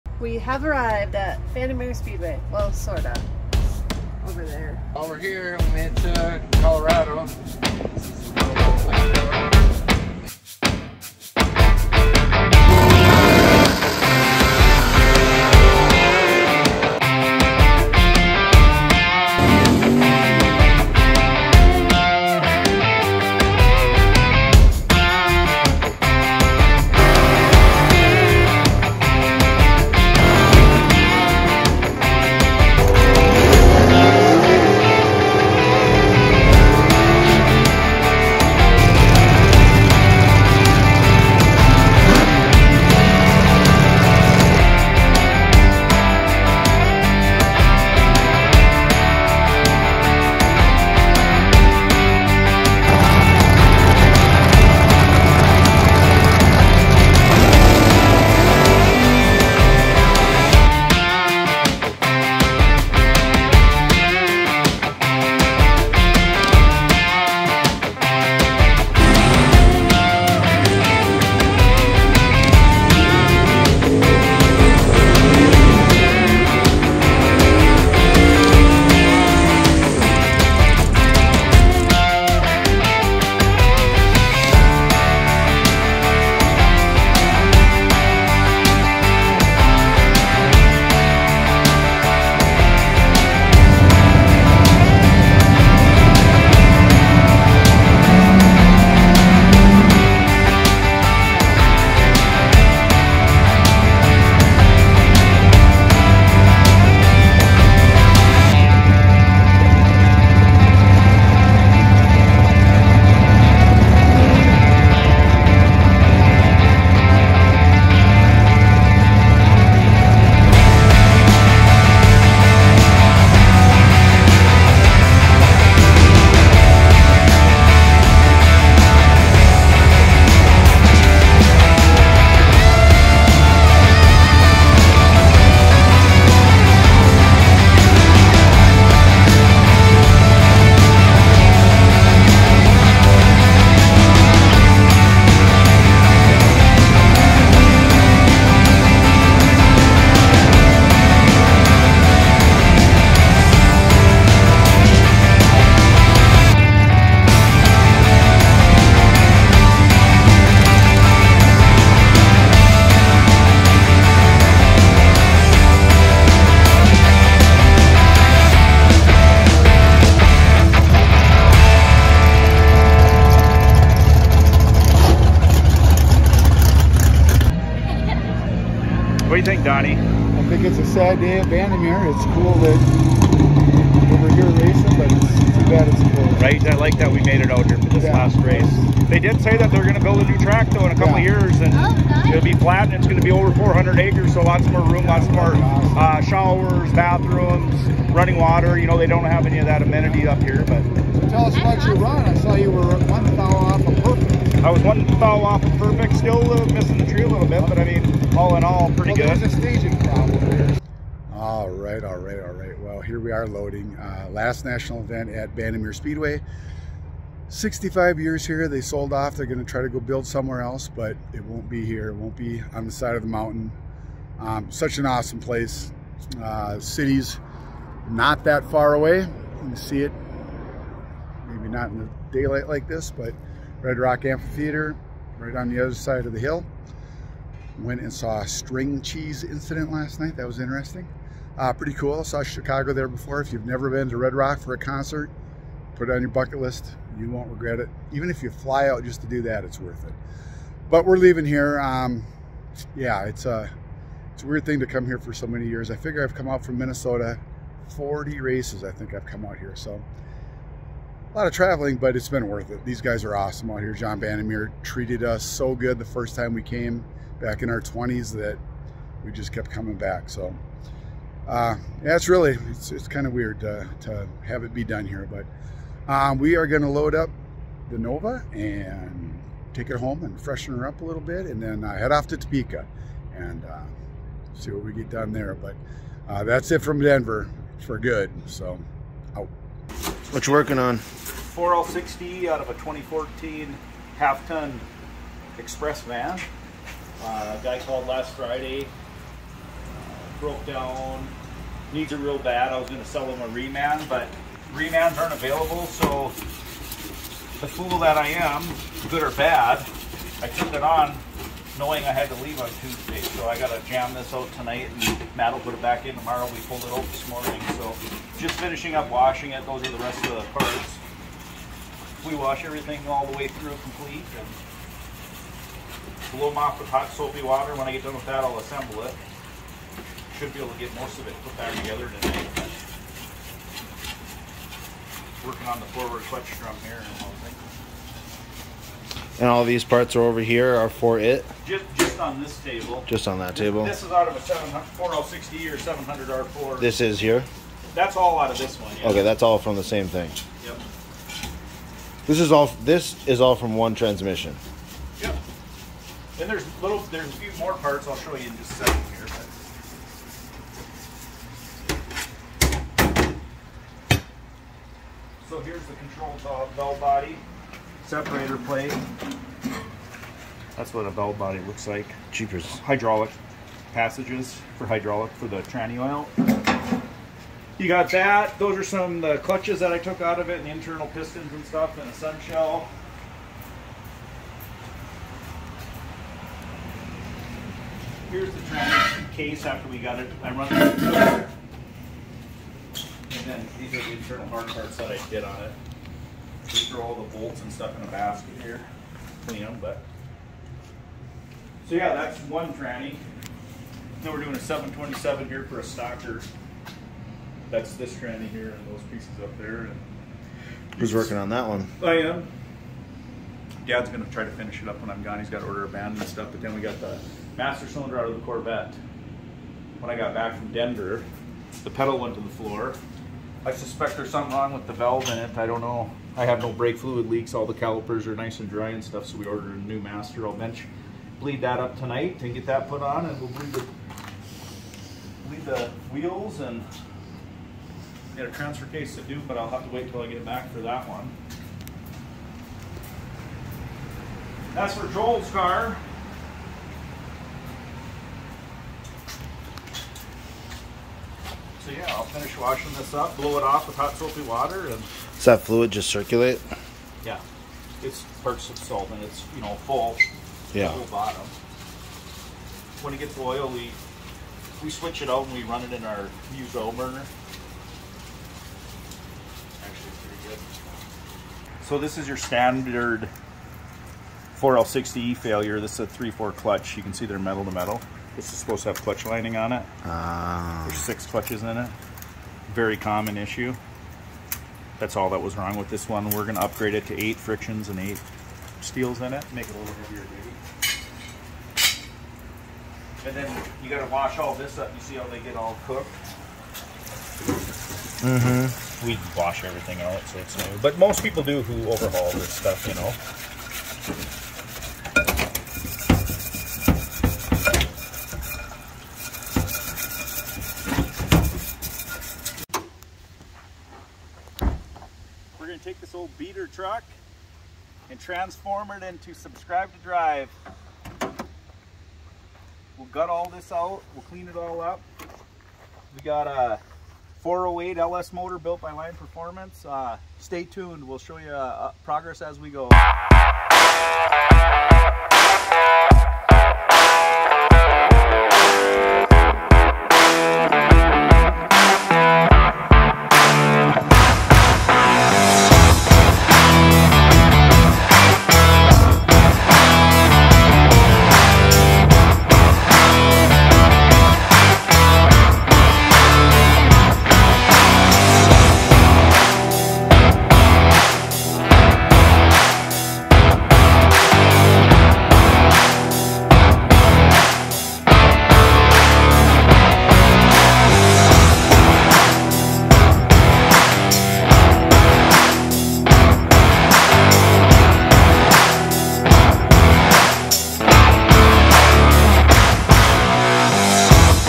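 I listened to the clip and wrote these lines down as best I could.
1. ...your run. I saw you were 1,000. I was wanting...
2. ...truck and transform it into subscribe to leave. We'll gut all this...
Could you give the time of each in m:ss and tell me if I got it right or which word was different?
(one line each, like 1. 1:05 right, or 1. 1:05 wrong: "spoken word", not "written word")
1. 3:21 right
2. 8:36 wrong: "drive", not "leave".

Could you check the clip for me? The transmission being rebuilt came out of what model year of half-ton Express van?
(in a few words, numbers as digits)
2014.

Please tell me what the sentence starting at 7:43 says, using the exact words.
When it gets oil, we, we switch it out and we run it in our used oil burner.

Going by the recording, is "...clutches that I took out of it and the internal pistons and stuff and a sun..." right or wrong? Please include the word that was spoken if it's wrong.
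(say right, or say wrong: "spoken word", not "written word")
right.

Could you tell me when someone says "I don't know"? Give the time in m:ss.
7:05.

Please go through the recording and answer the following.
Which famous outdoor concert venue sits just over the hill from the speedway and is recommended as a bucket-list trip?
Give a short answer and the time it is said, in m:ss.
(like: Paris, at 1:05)
Red Rock Amphitheater, at 3:53.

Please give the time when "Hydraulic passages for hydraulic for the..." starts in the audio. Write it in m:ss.
6:12.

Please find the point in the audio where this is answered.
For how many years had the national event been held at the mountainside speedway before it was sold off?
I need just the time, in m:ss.
3:37.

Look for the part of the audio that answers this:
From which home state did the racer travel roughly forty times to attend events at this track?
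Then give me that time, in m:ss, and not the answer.
4:16.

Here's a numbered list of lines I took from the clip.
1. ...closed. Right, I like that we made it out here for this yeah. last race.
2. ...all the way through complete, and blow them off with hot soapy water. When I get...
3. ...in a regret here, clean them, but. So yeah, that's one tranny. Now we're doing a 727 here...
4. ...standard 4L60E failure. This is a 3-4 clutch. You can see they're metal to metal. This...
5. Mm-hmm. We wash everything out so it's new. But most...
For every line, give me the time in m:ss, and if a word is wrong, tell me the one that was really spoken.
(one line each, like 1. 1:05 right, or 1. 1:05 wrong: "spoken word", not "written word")
1. 3:06 right
2. 5:23 right
3. 6:37 wrong: "basket", not "regret"
4. 7:52 right
5. 8:18 right.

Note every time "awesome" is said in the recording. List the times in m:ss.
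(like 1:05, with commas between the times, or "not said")
3:45, 4:23.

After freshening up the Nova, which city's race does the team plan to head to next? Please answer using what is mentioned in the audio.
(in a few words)
Topeka.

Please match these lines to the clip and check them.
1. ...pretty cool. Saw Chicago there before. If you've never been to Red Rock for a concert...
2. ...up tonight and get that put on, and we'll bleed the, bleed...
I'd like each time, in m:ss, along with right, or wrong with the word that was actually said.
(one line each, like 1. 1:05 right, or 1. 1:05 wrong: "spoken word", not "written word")
1. 4:01 right
2. 7:11 right.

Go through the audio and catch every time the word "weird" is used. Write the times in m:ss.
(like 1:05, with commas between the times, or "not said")
4:14, 4:33.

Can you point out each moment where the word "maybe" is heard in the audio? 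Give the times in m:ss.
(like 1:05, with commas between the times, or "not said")
3:51, 8:11.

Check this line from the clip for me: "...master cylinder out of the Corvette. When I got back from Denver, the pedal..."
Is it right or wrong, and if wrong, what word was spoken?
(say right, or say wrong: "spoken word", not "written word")
right.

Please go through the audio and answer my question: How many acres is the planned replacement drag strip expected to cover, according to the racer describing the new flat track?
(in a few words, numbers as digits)
400.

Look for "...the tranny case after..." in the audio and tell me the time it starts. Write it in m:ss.
6:28.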